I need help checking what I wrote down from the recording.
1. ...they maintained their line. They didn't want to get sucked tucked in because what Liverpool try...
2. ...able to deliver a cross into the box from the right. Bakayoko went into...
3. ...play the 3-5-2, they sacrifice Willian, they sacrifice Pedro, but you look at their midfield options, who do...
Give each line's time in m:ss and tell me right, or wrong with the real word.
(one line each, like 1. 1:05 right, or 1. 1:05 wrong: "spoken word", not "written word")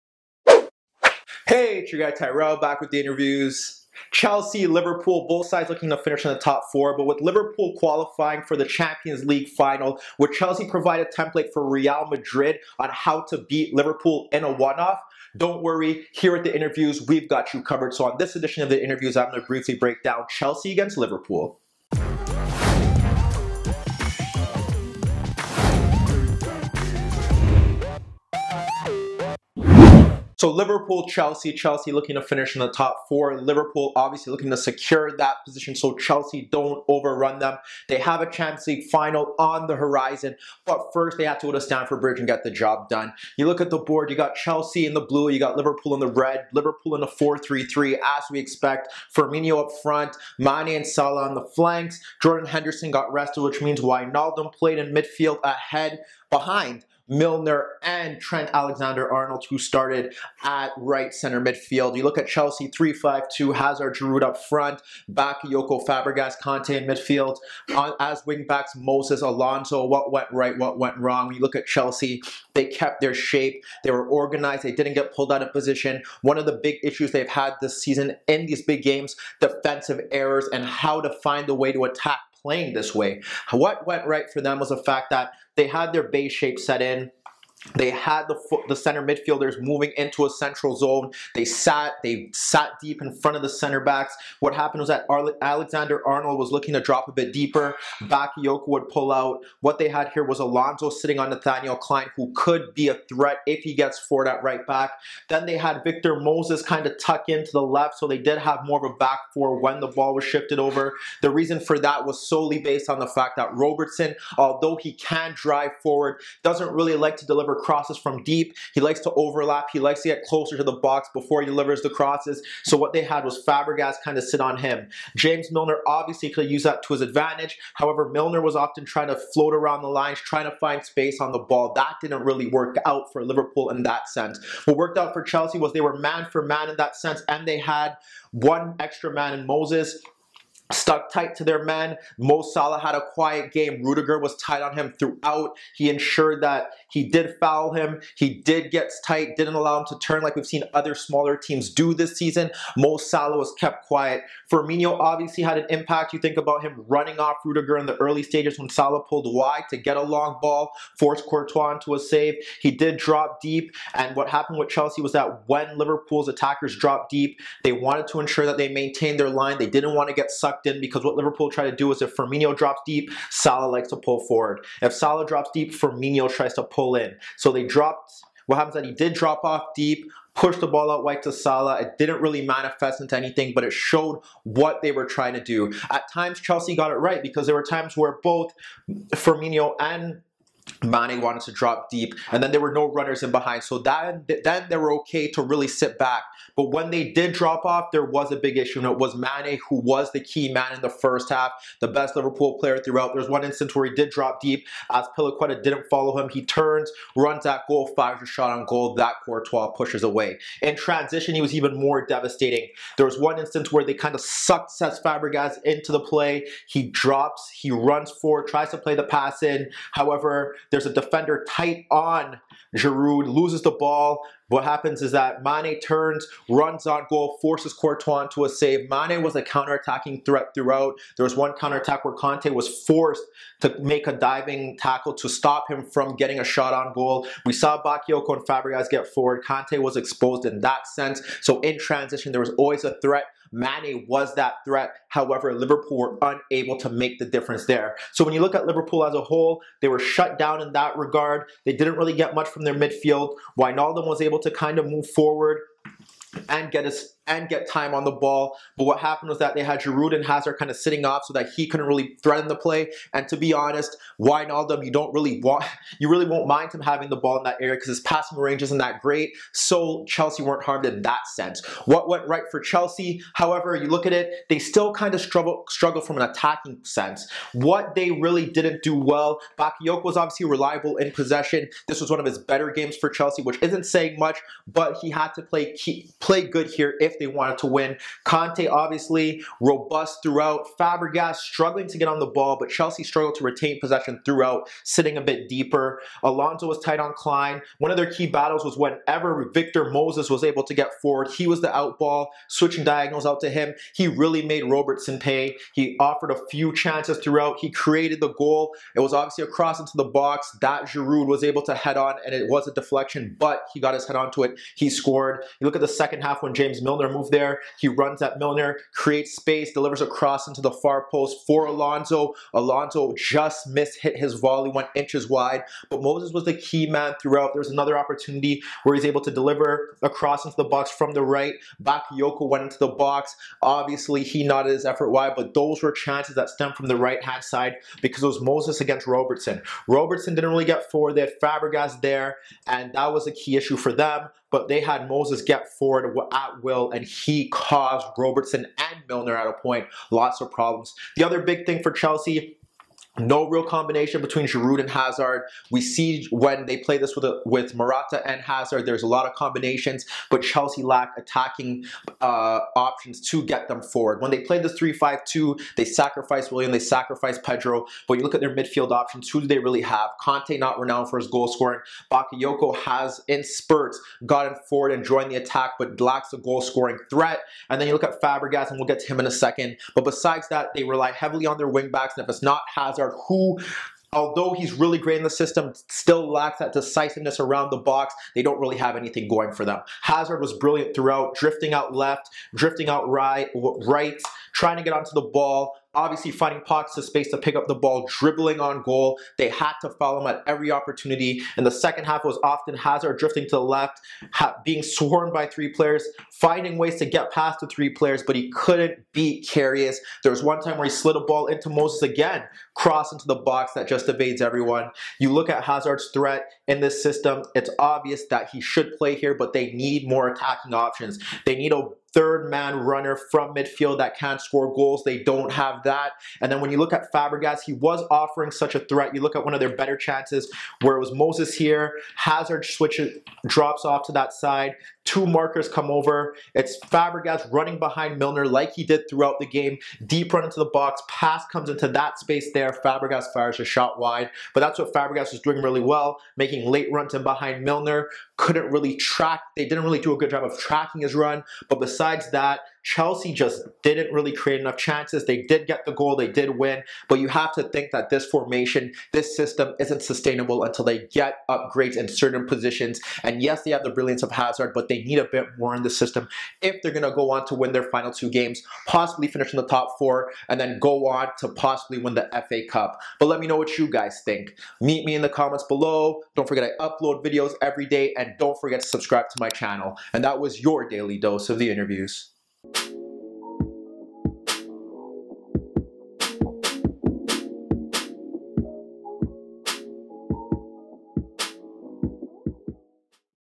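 1. 2:48 right
2. 5:29 right
3. 6:04 right.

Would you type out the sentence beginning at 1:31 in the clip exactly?
They sat they sat deep in front of the center backs.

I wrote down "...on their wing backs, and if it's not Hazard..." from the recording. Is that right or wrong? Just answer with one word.
right.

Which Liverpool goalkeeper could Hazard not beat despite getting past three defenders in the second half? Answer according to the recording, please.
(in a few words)
Karius.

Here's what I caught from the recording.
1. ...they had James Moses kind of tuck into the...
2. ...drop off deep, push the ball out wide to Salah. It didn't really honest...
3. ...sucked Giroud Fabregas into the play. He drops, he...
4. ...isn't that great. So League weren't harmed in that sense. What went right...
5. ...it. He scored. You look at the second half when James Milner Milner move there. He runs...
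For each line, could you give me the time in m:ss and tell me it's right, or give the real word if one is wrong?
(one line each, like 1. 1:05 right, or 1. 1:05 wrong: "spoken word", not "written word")
1. 1:45 wrong: "Victor", not "James"
2. 2:59 wrong: "manifest", not "honest"
3. 3:34 wrong: "Cesc", not "Giroud"
4. 4:28 wrong: "Chelsea", not "League"
5. 5:14 right.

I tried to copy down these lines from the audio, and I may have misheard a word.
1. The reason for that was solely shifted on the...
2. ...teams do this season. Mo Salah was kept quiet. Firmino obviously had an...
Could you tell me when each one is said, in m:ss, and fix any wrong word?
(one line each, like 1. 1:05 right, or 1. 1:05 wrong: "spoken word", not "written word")
1. 1:51 wrong: "based", not "shifted"
2. 2:31 right.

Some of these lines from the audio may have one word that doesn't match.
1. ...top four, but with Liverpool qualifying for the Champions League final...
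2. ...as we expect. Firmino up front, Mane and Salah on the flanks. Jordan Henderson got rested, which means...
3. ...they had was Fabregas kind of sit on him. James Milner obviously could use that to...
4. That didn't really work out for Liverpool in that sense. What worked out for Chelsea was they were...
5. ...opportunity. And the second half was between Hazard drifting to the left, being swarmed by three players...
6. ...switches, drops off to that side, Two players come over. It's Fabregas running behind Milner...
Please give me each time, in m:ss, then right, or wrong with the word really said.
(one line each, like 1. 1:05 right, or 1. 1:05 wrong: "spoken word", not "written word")
1. 0:06 right
2. 0:48 right
3. 2:02 right
4. 2:11 right
5. 6:40 wrong: "often", not "between"
6. 7:12 wrong: "markers", not "players".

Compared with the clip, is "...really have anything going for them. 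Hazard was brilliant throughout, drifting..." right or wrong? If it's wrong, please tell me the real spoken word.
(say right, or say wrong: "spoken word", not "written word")
right.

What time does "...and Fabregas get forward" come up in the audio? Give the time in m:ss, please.
3:58.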